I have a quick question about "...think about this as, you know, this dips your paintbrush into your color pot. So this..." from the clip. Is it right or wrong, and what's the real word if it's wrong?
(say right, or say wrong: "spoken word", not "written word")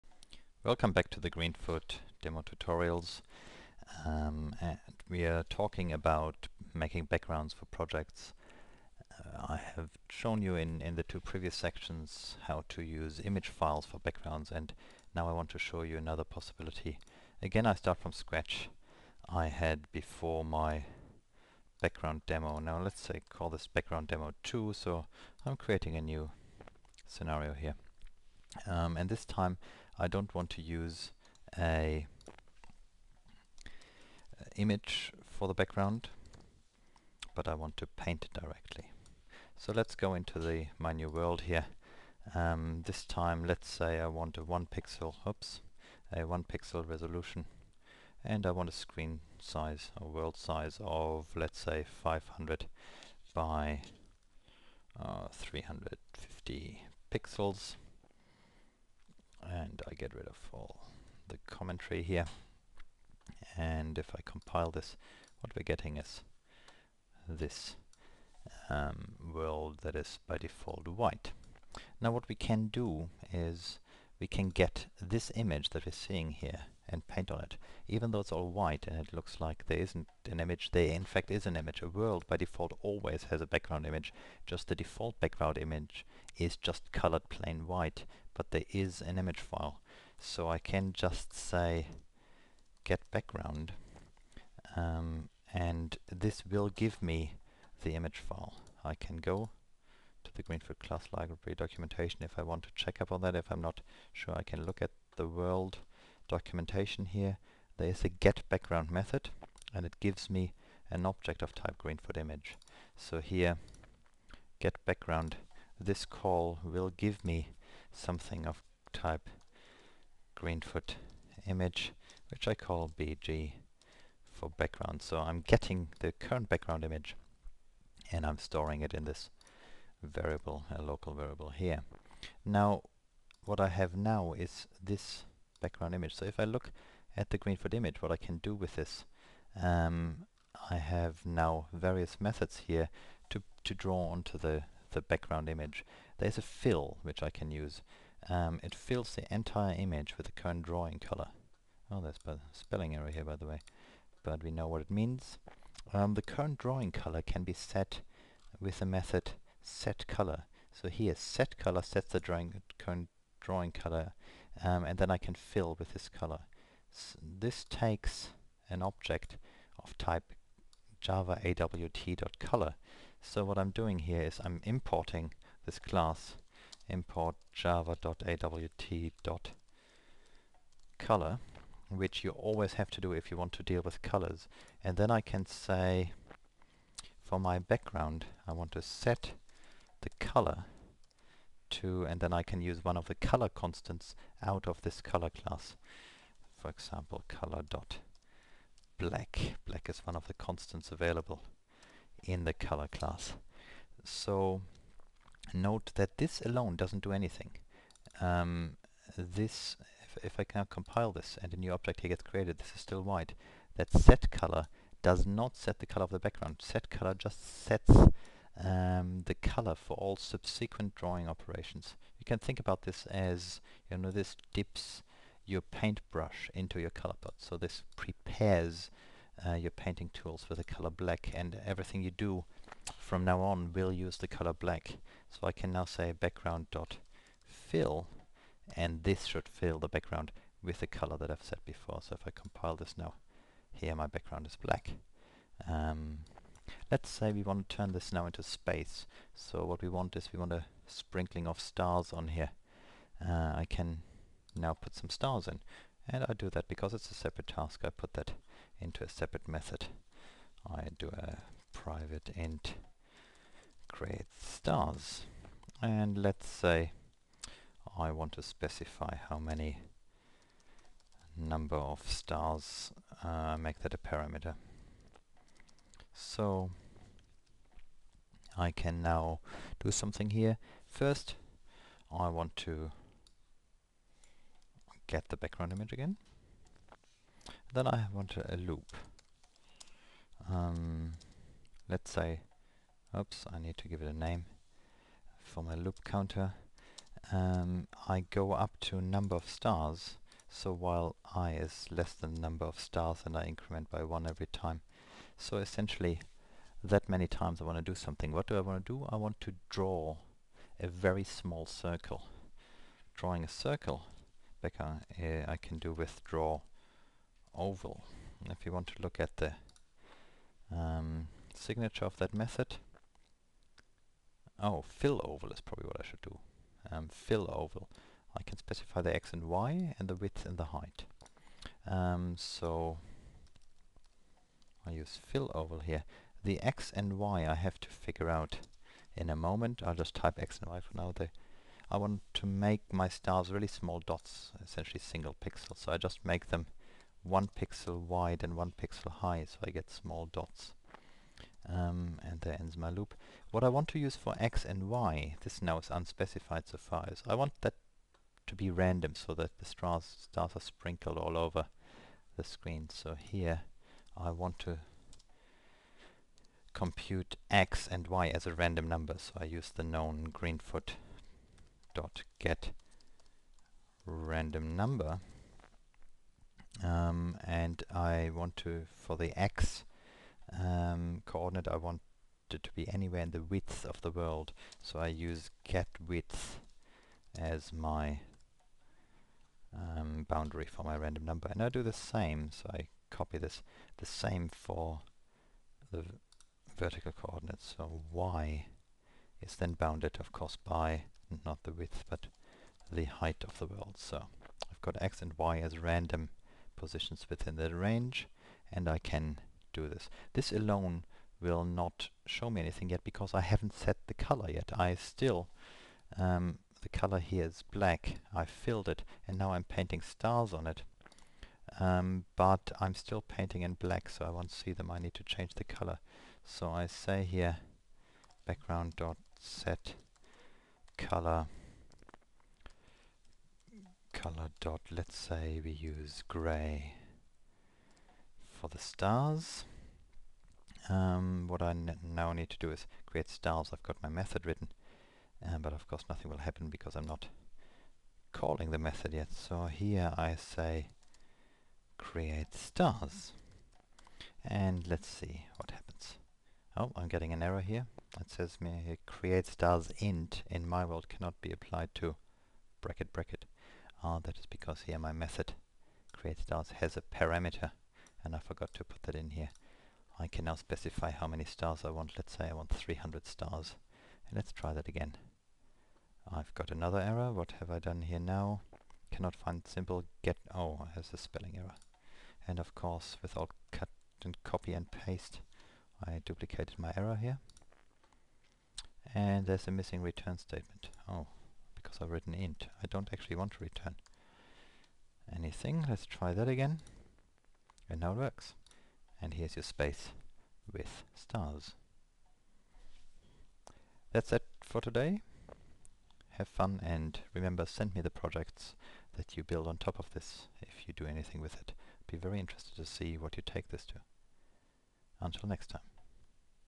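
right.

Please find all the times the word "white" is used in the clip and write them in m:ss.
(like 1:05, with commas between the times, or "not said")
1:10, 1:18, 1:27, 3:33.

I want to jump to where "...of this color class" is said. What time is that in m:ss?
3:14.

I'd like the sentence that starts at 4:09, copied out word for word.
So what we want is we want a sprinkling of stars on here.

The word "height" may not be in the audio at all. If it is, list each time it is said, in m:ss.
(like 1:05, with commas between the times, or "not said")
5:30, 6:43.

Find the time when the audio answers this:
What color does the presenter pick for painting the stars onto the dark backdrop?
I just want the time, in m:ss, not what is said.
7:16.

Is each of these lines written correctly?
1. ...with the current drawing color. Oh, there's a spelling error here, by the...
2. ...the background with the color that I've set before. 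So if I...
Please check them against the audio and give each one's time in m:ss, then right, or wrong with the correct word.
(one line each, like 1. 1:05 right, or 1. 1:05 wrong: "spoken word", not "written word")
1. 2:30 right
2. 3:59 right.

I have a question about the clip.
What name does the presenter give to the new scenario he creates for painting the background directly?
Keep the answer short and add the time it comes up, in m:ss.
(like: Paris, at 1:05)
background demo 2, at 0:23.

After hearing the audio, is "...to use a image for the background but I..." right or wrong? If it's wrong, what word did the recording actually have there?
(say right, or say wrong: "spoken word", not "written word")
right.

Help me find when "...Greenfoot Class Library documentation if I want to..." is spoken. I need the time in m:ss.
1:40.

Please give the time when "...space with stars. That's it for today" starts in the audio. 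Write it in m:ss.
8:19.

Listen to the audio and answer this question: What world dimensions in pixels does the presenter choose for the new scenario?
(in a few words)
500 by 350.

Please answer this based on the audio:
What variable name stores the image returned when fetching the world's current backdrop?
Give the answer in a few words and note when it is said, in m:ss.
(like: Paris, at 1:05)
BG, at 2:02.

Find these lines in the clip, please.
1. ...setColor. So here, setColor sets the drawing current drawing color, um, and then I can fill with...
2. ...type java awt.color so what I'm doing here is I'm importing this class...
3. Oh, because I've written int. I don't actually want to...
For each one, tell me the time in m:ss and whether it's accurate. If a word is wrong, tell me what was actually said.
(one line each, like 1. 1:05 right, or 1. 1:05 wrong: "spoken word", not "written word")
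1. 2:39 right
2. 2:49 right
3. 8:11 right.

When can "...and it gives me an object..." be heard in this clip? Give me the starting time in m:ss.
1:49.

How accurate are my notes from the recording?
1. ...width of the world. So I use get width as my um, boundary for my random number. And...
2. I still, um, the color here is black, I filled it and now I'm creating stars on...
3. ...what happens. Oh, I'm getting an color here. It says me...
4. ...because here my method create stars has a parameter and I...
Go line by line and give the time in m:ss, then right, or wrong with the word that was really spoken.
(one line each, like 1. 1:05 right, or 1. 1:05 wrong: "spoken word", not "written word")
1. 6:23 right
2. 6:54 wrong: "painting", not "creating"
3. 7:35 wrong: "error", not "color"
4. 7:44 right.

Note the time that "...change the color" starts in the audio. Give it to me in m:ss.
7:05.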